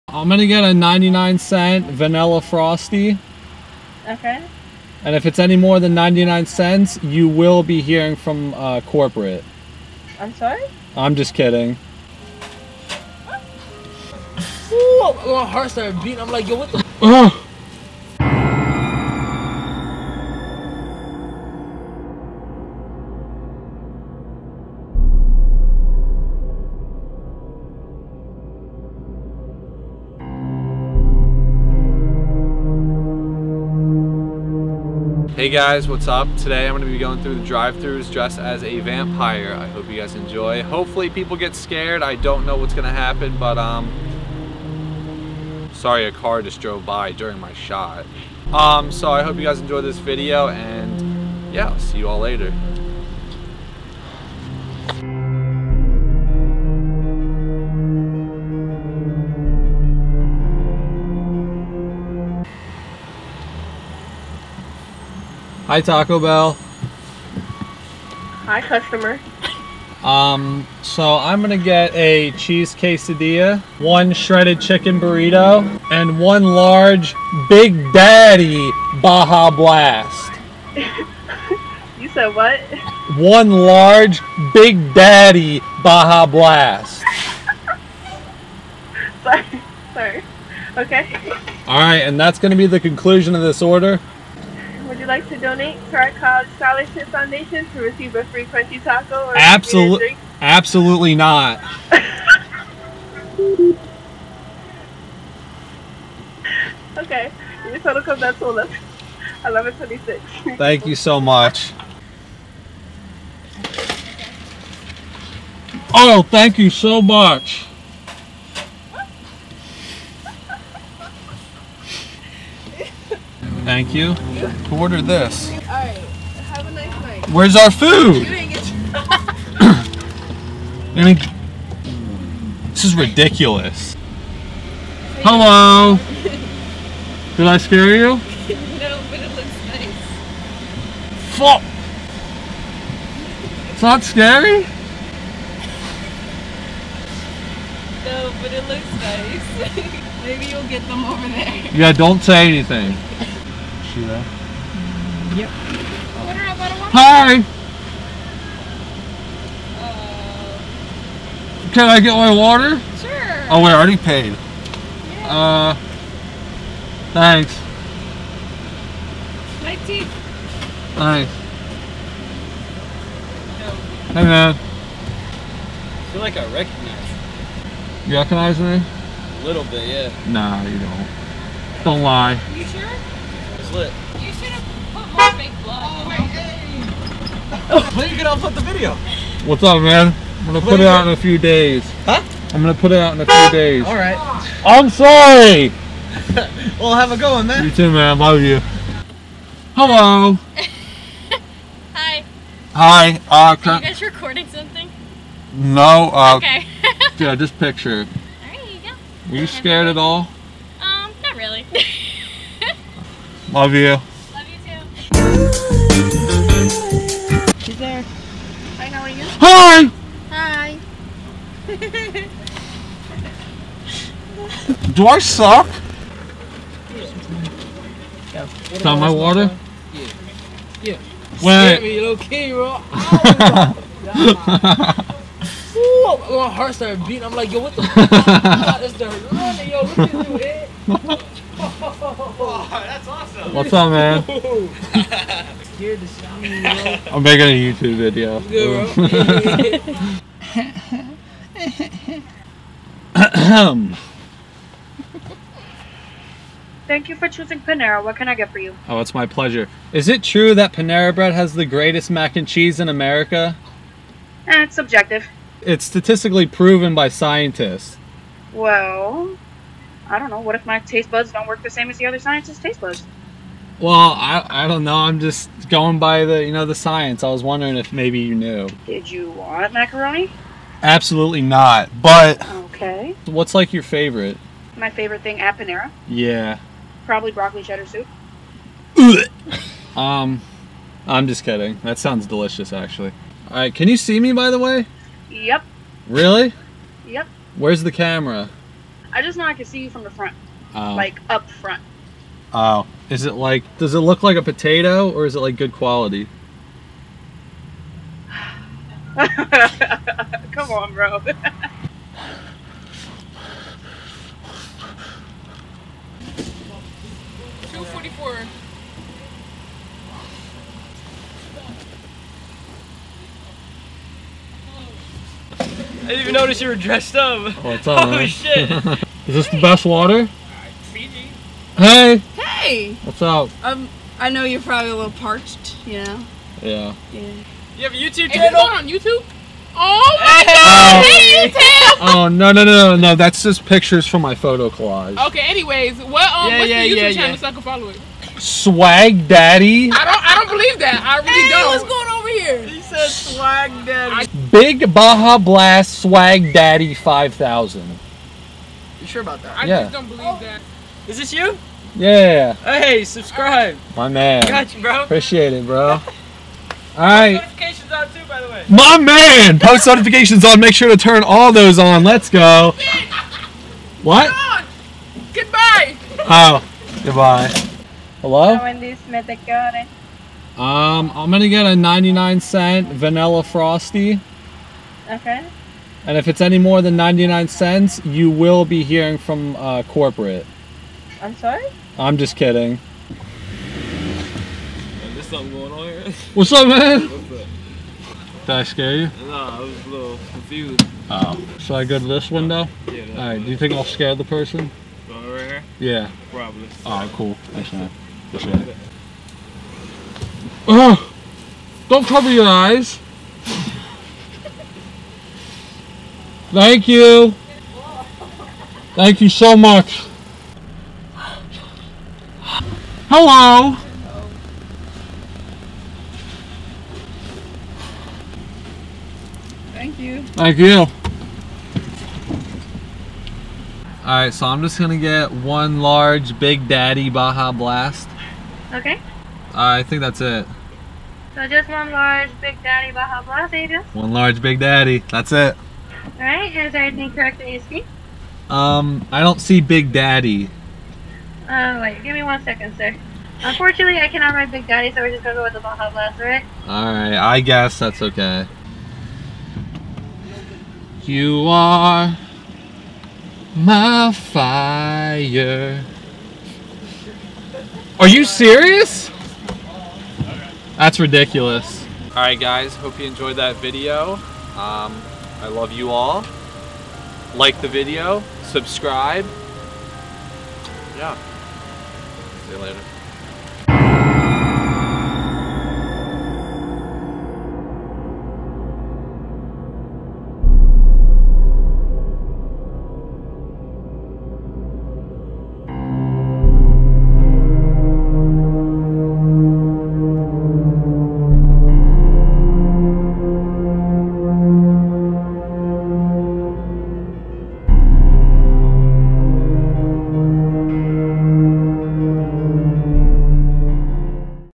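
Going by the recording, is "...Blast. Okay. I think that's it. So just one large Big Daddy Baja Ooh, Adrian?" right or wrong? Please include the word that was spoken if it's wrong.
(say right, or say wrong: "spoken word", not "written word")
wrong: "Blast", not "Ooh".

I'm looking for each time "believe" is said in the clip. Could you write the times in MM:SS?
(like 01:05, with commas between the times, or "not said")
05:50, 06:00.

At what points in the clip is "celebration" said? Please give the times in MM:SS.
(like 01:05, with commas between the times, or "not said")
not said.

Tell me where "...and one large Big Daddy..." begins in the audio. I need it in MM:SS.
01:15.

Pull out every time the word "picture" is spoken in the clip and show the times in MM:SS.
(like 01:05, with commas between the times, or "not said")
03:27, 05:43.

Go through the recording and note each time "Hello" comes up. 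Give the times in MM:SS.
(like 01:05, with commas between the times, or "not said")
02:15, 03:19, 06:18, 07:03.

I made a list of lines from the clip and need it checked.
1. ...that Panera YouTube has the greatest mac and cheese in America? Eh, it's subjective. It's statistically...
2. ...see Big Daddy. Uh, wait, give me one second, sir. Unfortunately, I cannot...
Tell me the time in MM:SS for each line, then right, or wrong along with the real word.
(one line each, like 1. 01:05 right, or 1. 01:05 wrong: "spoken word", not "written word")
1. 04:20 wrong: "Bread", not "YouTube"
2. 07:29 right.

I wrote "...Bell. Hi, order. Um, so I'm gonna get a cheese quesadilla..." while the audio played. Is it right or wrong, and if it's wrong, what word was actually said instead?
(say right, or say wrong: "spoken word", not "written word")
wrong: "customer", not "order".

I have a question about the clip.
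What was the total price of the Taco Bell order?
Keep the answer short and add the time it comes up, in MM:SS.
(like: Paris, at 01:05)
$11.26, at 01:48.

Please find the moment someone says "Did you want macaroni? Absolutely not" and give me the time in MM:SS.
04:38.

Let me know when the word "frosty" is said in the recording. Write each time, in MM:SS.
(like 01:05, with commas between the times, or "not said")
00:02, 06:23.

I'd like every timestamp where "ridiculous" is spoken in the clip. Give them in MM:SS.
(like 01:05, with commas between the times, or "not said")
02:12, 07:51.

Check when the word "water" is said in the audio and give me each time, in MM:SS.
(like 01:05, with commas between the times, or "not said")
02:42, 03:49, 05:29.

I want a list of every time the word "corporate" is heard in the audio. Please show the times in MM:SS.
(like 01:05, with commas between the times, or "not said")
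00:08, 06:29.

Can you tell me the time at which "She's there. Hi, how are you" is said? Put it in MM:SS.
03:37.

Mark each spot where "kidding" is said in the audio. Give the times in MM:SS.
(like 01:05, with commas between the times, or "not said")
00:11, 04:51, 06:32.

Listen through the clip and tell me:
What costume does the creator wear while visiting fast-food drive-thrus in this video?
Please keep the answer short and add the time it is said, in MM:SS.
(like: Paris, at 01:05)
vampire, at 00:38.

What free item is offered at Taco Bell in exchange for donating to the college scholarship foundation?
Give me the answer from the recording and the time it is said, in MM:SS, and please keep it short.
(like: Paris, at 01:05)
crunchy taco, at 01:38.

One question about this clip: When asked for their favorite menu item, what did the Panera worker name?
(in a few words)
broccoli cheddar soup.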